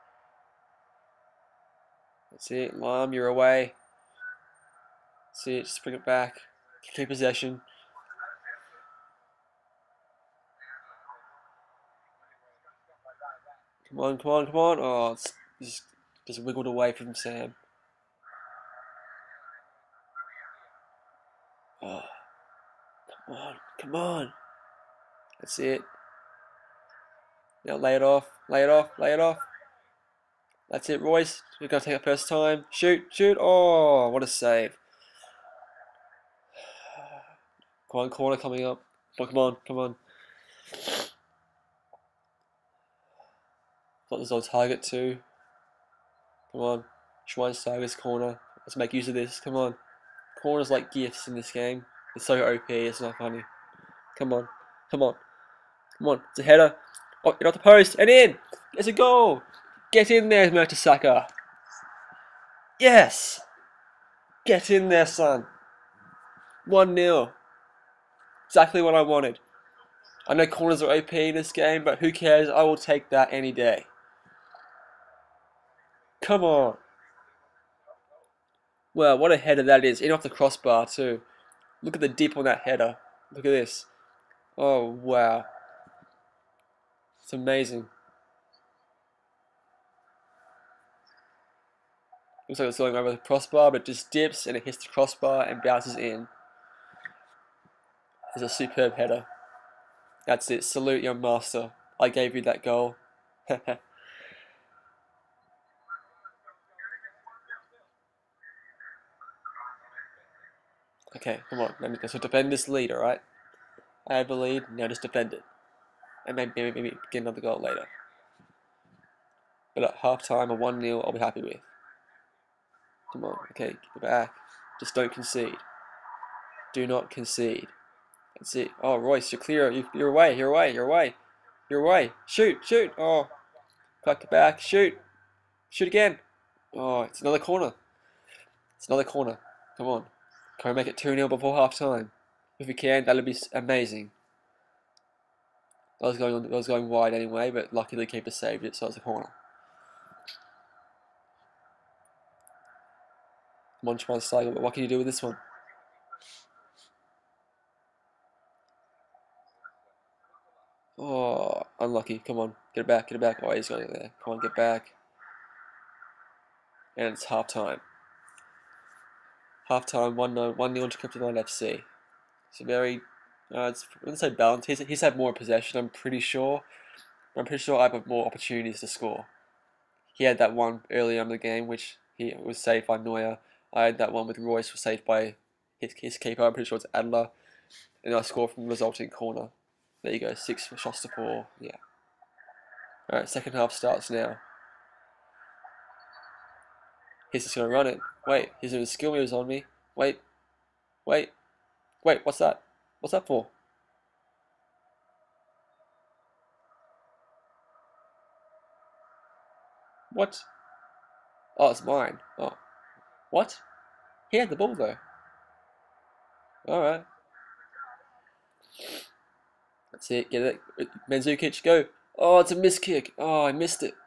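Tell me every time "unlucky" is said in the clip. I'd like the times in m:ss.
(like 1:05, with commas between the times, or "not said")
2:41.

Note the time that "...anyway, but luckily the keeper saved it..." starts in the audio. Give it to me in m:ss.
2:27.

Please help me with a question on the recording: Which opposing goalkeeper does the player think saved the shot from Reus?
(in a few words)
Adler.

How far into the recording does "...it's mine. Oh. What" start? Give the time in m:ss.
3:31.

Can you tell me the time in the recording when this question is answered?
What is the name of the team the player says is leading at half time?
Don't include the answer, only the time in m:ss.
2:50.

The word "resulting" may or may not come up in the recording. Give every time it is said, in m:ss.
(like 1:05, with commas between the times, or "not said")
3:08.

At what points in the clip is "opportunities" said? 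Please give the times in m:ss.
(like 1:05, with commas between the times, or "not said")
2:58.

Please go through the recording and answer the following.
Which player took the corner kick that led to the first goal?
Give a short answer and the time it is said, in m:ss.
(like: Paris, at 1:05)
Schweinsteiger, at 0:47.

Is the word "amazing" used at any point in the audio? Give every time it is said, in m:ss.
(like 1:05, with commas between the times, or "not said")
1:27, 2:23.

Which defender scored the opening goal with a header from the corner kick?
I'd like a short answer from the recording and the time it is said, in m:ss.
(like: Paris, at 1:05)
Mertesacker, at 1:00.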